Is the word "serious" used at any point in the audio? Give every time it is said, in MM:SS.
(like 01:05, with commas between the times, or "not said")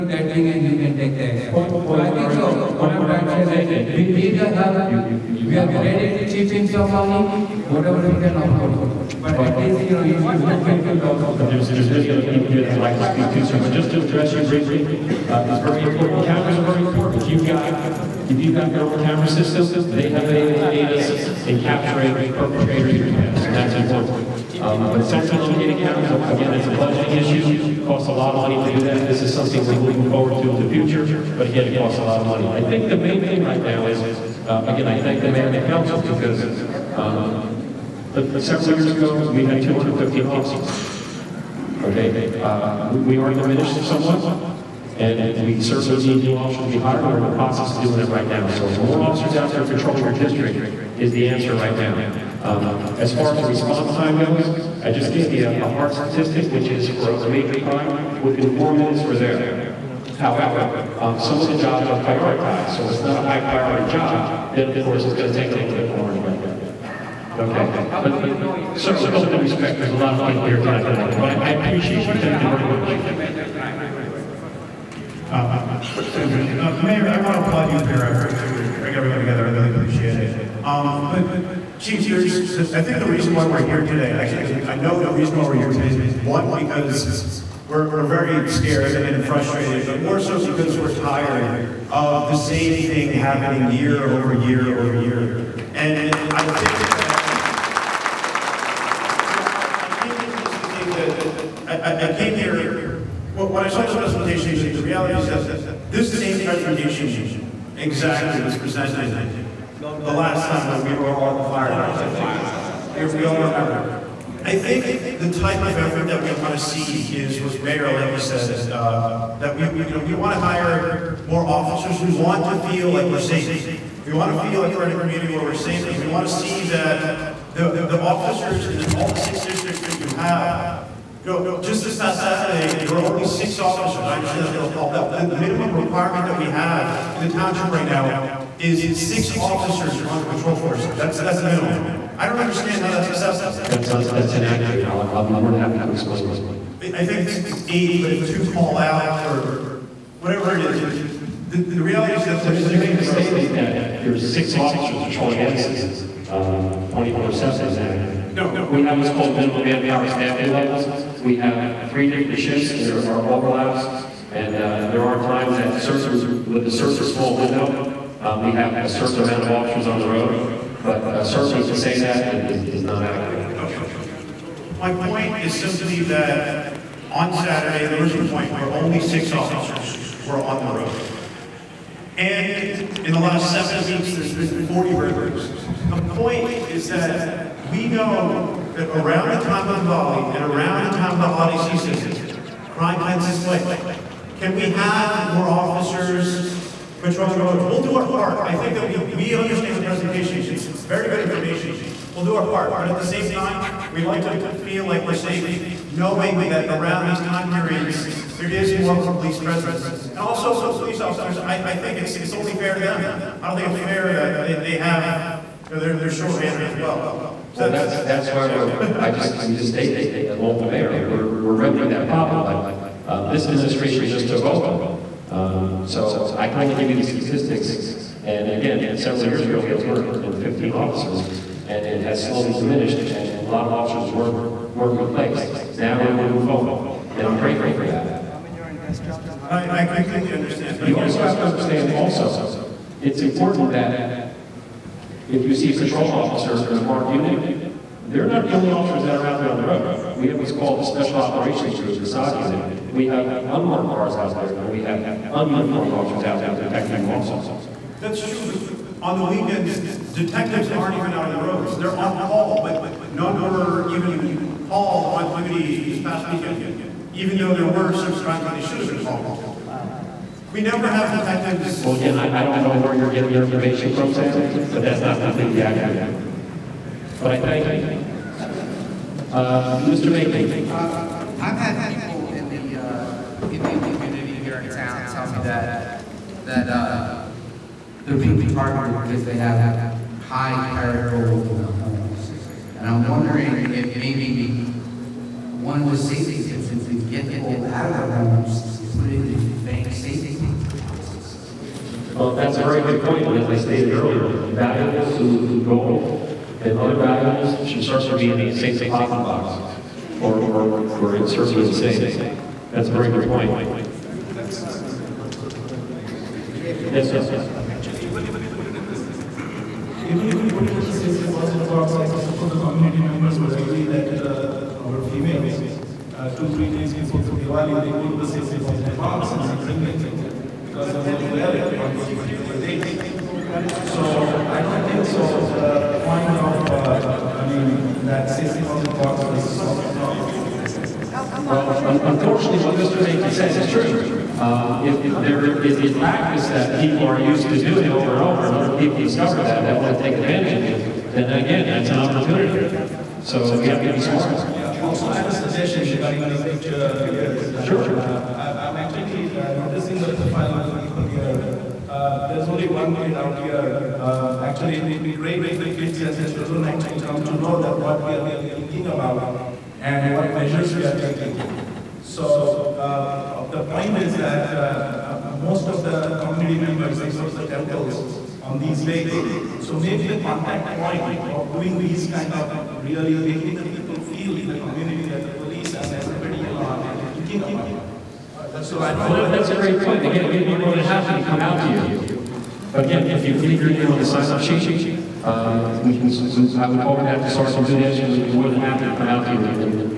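not said.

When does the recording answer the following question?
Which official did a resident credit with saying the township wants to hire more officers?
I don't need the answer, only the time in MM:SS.
01:57.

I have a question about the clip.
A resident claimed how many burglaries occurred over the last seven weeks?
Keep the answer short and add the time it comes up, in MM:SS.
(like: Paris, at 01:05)
40, at 03:04.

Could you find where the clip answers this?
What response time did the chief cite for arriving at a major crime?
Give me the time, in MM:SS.
00:58.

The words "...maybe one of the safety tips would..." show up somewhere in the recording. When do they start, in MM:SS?
04:53.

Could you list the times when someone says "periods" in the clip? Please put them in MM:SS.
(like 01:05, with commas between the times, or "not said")
03:27.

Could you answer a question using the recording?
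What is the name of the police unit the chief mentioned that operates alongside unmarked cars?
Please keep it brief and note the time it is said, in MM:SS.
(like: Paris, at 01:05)
Special Operations Group, at 04:10.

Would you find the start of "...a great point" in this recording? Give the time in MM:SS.
06:29.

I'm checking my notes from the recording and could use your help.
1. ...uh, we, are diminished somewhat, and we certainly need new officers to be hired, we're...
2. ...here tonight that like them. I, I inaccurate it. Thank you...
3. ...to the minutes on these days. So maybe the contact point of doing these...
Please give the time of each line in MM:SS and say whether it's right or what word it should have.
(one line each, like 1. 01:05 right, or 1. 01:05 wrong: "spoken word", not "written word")
1. 00:42 right
2. 01:10 wrong: "appreciate", not "inaccurate"
3. 06:17 wrong: "temples", not "minutes".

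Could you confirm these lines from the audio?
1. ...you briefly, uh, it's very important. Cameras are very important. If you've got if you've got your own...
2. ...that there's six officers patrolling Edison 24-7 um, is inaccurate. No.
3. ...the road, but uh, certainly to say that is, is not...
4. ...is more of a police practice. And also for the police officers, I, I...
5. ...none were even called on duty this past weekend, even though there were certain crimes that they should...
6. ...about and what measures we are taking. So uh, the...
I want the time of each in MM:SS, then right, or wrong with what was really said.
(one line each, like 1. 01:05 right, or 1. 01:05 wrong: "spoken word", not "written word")
1. 00:14 right
2. 02:33 right
3. 02:49 right
4. 03:28 wrong: "presence", not "practice"
5. 04:23 right
6. 06:08 right.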